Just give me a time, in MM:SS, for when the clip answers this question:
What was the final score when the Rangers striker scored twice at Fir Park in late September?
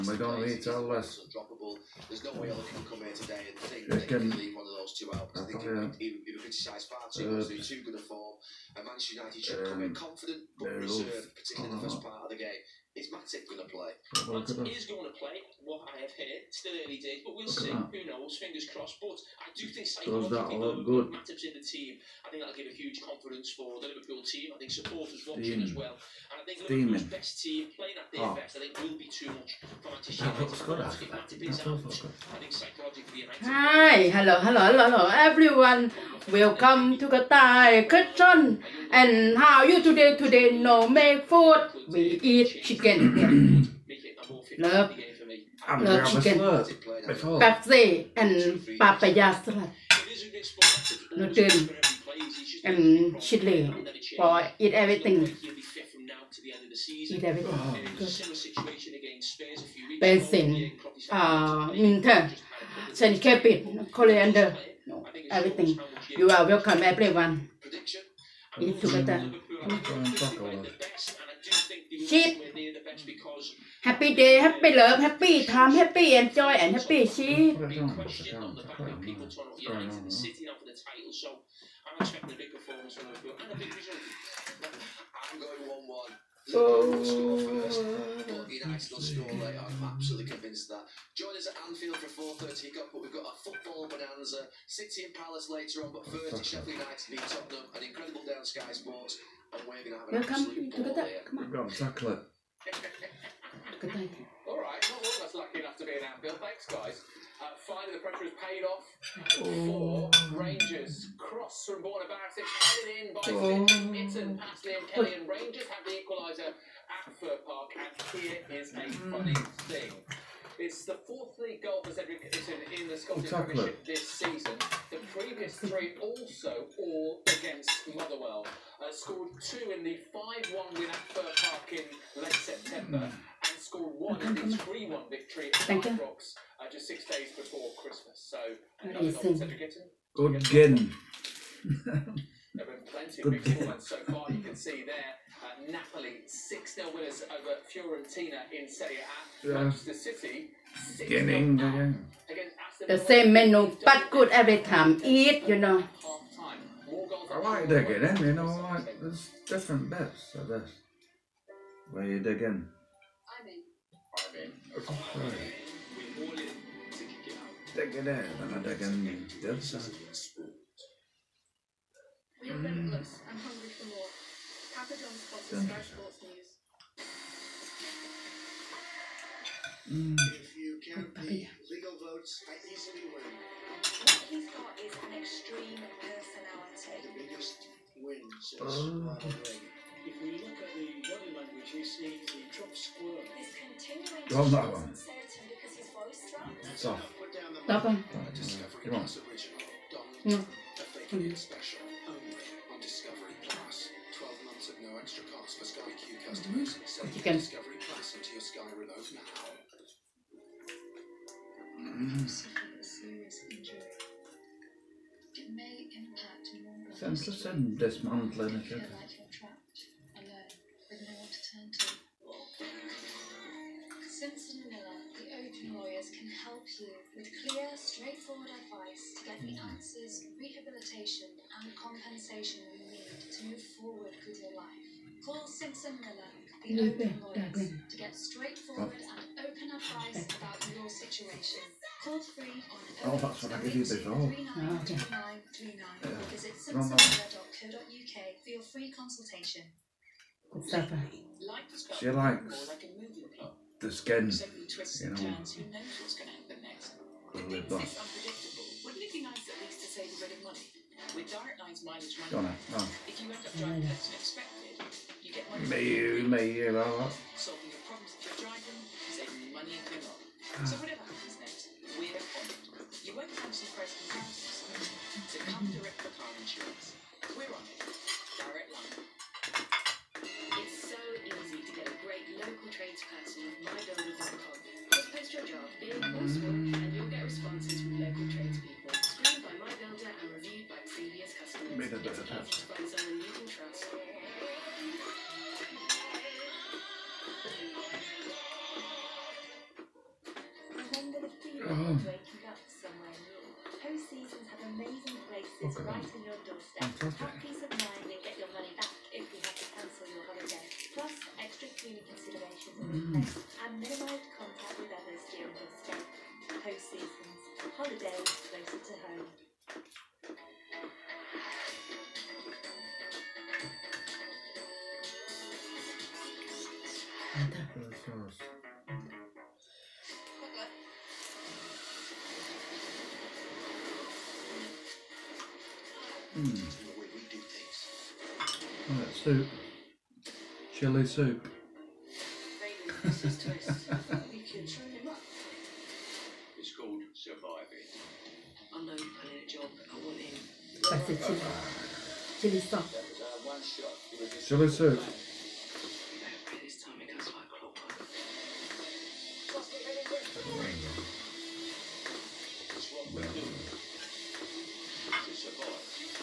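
02:10.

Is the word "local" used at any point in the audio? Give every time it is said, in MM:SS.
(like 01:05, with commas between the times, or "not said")
04:42, 04:48.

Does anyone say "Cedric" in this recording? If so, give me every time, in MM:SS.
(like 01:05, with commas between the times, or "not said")
02:01, 02:19.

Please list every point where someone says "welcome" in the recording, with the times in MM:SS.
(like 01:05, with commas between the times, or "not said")
00:36, 01:06.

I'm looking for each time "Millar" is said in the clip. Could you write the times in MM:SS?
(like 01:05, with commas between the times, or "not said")
03:44, 03:56.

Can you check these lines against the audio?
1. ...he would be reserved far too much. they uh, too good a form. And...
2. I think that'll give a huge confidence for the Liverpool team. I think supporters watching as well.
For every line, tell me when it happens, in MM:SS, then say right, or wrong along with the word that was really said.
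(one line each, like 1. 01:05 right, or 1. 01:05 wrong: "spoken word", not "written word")
1. 00:05 wrong: "criticised", not "reserved"
2. 00:22 right.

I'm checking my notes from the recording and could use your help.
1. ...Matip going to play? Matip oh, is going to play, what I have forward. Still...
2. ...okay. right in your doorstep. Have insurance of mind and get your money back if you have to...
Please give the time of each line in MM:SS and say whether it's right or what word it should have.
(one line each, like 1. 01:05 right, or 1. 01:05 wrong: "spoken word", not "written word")
1. 00:13 wrong: "heard", not "forward"
2. 05:05 wrong: "peace", not "insurance".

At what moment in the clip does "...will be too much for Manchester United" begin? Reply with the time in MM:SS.
00:28.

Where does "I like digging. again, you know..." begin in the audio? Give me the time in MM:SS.
02:37.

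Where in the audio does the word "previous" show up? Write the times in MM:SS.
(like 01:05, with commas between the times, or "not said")
02:05, 04:50.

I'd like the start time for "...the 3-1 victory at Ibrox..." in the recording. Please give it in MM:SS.
02:14.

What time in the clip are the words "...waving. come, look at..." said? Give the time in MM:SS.
01:39.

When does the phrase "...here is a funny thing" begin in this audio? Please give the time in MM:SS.
01:58.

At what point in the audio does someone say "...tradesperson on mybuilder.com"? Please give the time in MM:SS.
04:42.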